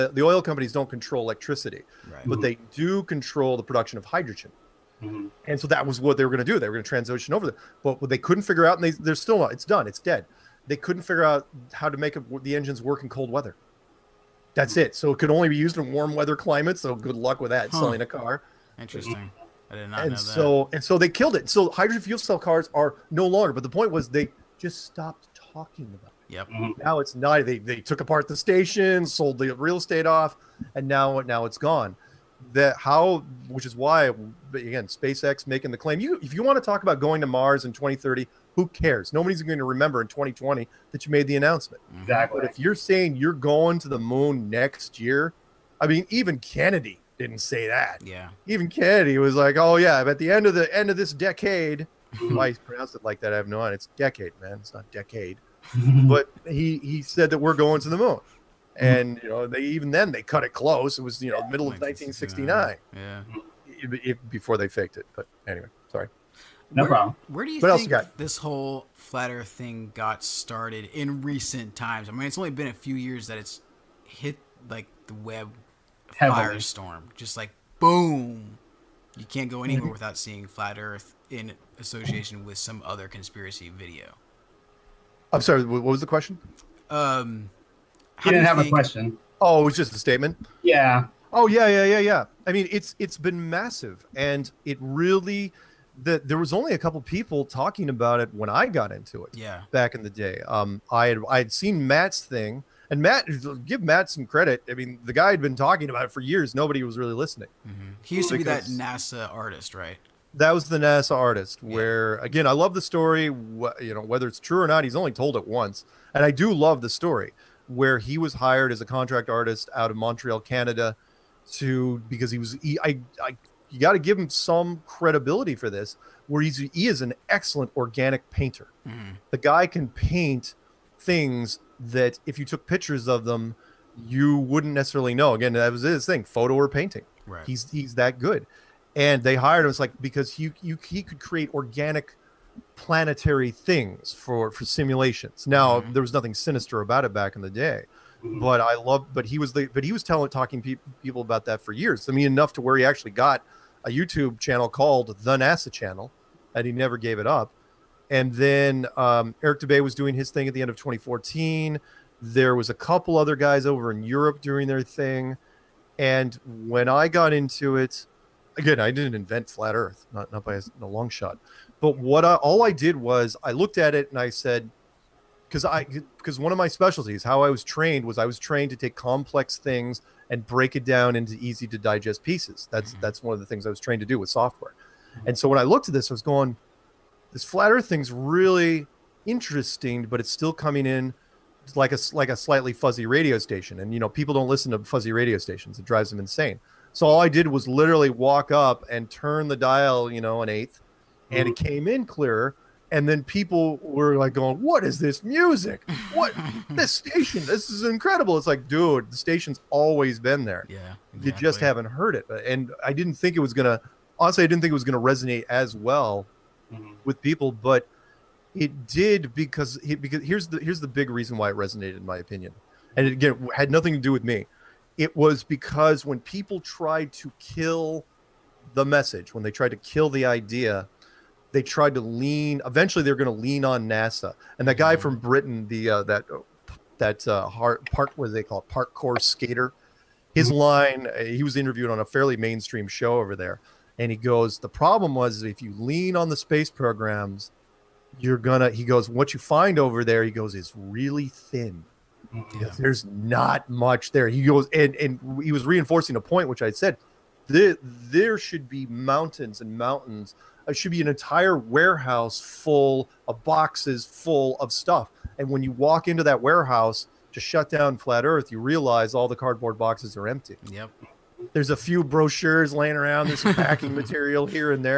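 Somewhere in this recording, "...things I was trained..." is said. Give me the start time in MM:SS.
03:03.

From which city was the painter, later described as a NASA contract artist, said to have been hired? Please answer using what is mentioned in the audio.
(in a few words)
Montreal.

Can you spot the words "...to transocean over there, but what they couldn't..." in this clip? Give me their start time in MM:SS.
00:06.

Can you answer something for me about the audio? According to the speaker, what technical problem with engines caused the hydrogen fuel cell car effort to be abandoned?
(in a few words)
Cold weather.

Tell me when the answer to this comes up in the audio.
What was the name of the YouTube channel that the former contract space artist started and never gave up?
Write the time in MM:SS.
02:35.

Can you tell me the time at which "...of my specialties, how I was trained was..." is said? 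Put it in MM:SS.
02:56.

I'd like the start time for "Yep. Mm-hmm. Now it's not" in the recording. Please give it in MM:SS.
00:26.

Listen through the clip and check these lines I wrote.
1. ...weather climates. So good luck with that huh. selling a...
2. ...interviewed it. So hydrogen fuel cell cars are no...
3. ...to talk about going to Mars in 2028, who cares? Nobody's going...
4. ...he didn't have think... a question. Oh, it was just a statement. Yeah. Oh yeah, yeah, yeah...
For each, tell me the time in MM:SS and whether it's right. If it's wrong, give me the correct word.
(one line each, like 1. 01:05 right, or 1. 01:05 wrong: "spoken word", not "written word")
1. 00:16 right
2. 00:21 wrong: "killed", not "interviewed"
3. 00:36 wrong: "2030", not "2028"
4. 01:28 right.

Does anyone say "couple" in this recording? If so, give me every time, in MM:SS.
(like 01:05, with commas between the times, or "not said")
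01:36, 02:42.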